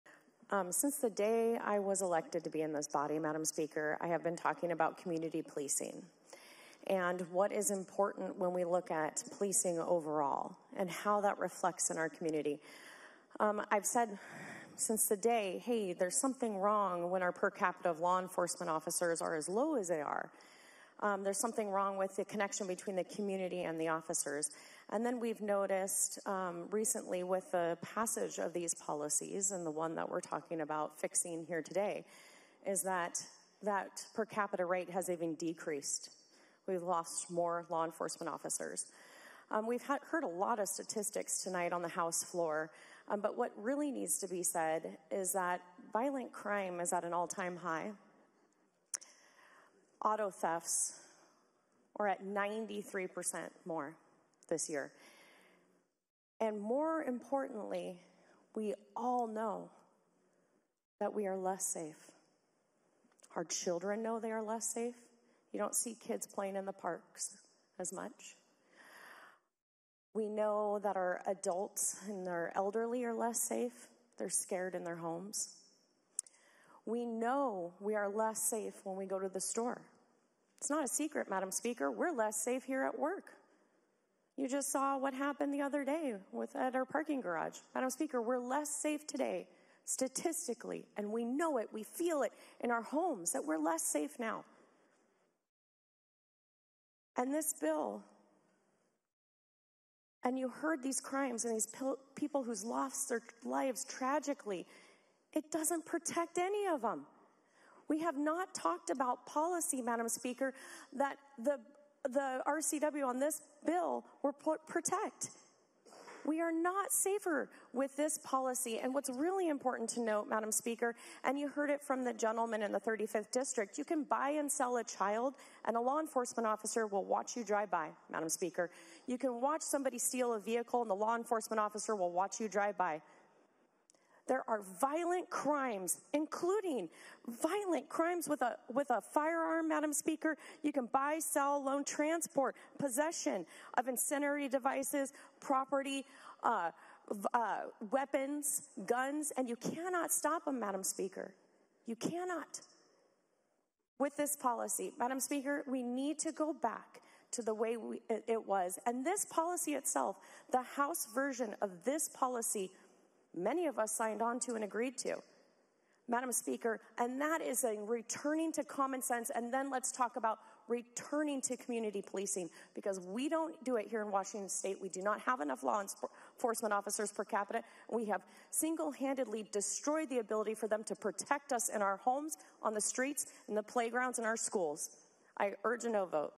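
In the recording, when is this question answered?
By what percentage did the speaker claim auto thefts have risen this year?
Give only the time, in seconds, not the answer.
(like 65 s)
52 s.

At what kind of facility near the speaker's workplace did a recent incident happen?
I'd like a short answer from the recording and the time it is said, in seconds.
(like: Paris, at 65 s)
parking garage, at 86 s.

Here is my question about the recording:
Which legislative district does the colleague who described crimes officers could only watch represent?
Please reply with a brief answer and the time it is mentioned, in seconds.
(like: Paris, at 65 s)
35th District, at 122 s.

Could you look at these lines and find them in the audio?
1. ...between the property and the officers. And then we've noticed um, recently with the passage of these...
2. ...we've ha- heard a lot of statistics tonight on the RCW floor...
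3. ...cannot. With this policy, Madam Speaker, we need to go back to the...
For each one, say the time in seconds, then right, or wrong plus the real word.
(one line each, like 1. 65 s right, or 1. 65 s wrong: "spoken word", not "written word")
1. 22 s wrong: "community", not "property"
2. 39 s wrong: "House", not "RCW"
3. 151 s right.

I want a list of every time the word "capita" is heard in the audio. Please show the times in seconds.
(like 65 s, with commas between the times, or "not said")
17 s, 34 s, 177 s.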